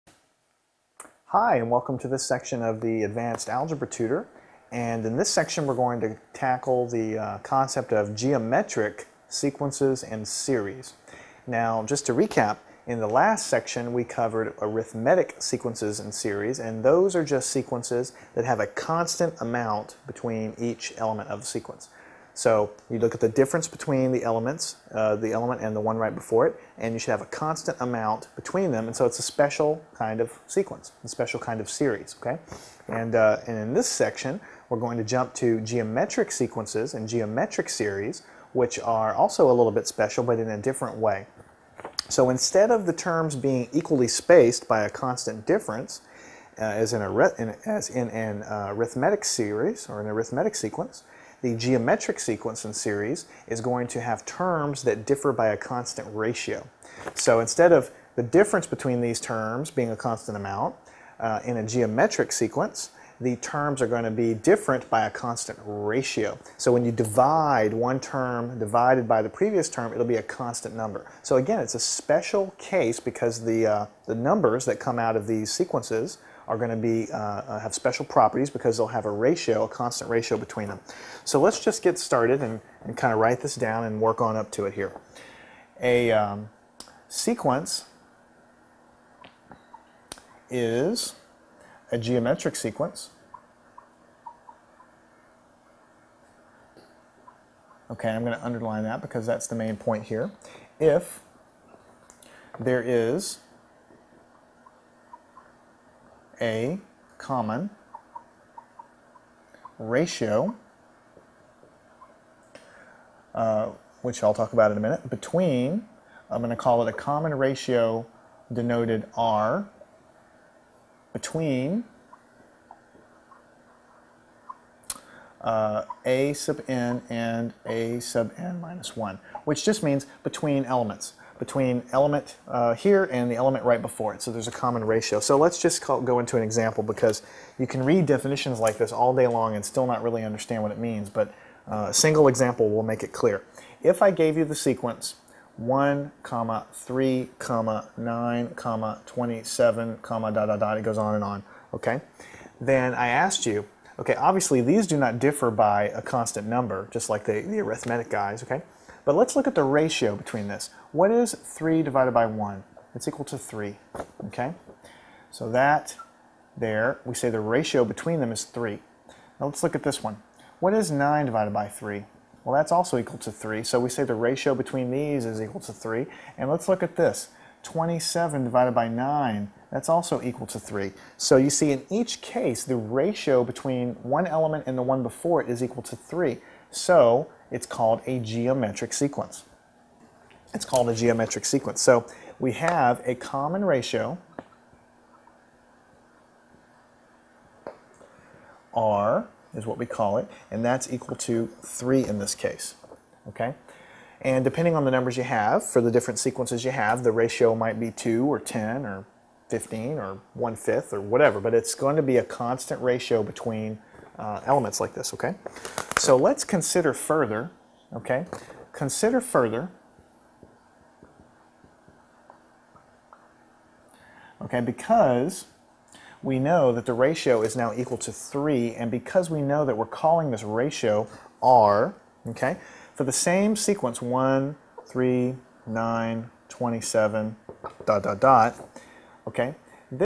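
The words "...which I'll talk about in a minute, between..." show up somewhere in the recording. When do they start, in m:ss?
1:54.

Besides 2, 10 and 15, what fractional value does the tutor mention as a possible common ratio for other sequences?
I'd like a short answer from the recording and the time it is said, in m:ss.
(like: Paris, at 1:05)
one fifth, at 3:30.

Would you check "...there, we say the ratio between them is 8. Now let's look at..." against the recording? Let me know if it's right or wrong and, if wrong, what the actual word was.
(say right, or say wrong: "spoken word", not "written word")
wrong: "3", not "8".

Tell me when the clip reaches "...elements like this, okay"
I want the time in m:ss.
3:34.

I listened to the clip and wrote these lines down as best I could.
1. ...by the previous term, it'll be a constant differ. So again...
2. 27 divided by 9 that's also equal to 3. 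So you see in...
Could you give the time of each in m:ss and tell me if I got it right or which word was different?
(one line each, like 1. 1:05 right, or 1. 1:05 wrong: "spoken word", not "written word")
1. 1:09 wrong: "number", not "differ"
2. 2:57 right.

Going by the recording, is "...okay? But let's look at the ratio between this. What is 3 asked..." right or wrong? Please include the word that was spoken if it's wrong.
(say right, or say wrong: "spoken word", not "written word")
wrong: "divided", not "asked".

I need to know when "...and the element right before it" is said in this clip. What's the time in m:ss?
2:13.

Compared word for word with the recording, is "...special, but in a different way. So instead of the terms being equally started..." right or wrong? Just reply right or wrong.
wrong.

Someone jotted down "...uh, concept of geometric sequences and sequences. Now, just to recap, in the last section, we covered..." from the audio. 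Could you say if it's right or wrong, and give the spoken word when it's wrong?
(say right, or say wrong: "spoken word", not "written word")
wrong: "series", not "sequences".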